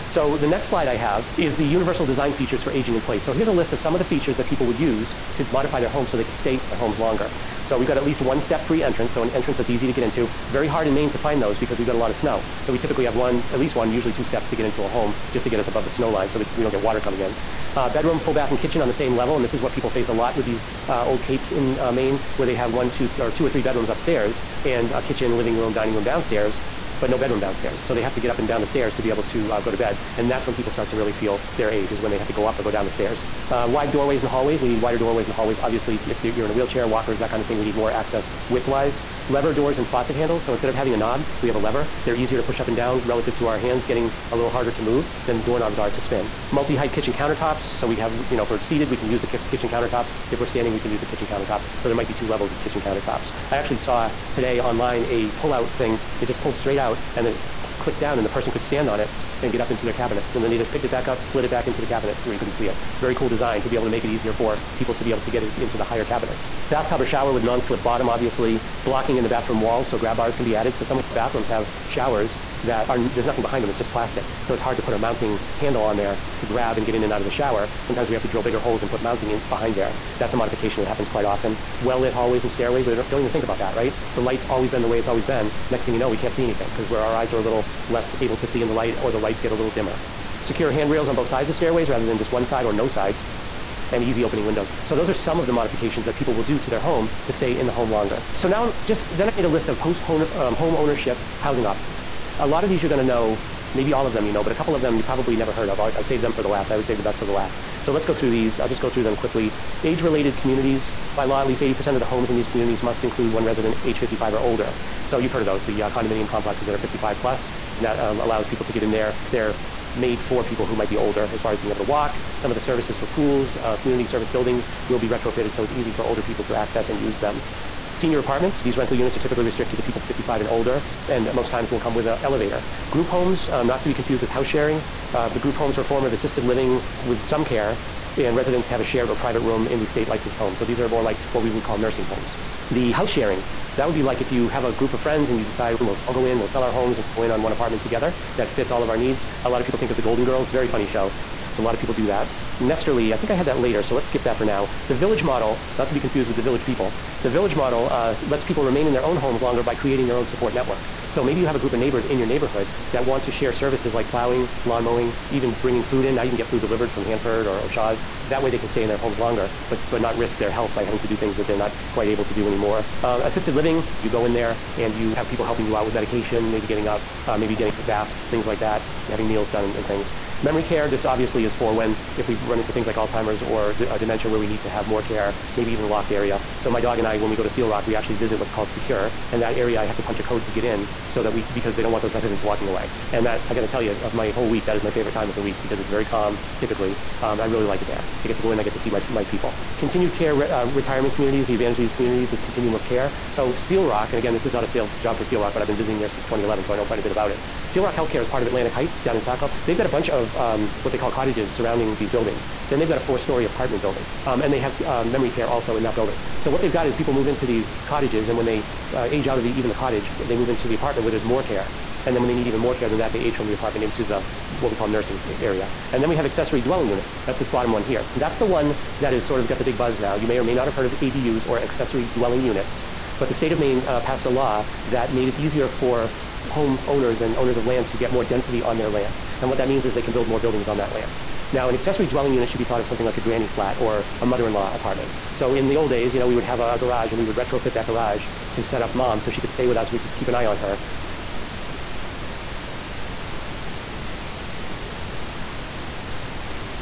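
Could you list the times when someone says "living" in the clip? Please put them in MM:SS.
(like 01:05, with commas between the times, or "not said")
00:25, 02:16, 02:53.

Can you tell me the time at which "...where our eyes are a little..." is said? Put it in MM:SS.
01:26.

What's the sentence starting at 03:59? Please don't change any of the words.
And what that means is they can build more buildings on that land.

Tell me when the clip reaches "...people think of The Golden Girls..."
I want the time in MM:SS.
02:29.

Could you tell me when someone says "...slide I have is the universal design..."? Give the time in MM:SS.
00:00.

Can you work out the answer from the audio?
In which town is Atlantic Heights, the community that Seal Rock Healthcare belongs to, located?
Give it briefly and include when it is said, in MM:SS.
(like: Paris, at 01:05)
Saco, at 03:29.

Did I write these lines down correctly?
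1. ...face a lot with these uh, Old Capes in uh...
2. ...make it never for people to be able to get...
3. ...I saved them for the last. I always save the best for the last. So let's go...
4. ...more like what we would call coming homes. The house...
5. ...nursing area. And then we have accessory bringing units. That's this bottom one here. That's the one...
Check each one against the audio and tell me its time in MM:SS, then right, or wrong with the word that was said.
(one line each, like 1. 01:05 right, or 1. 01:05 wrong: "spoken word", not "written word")
1. 00:19 right
2. 01:03 wrong: "easier", not "never"
3. 01:45 right
4. 02:20 wrong: "nursing", not "coming"
5. 03:44 wrong: "dwelling", not "bringing".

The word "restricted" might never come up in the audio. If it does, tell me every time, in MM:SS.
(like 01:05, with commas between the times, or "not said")
02:09.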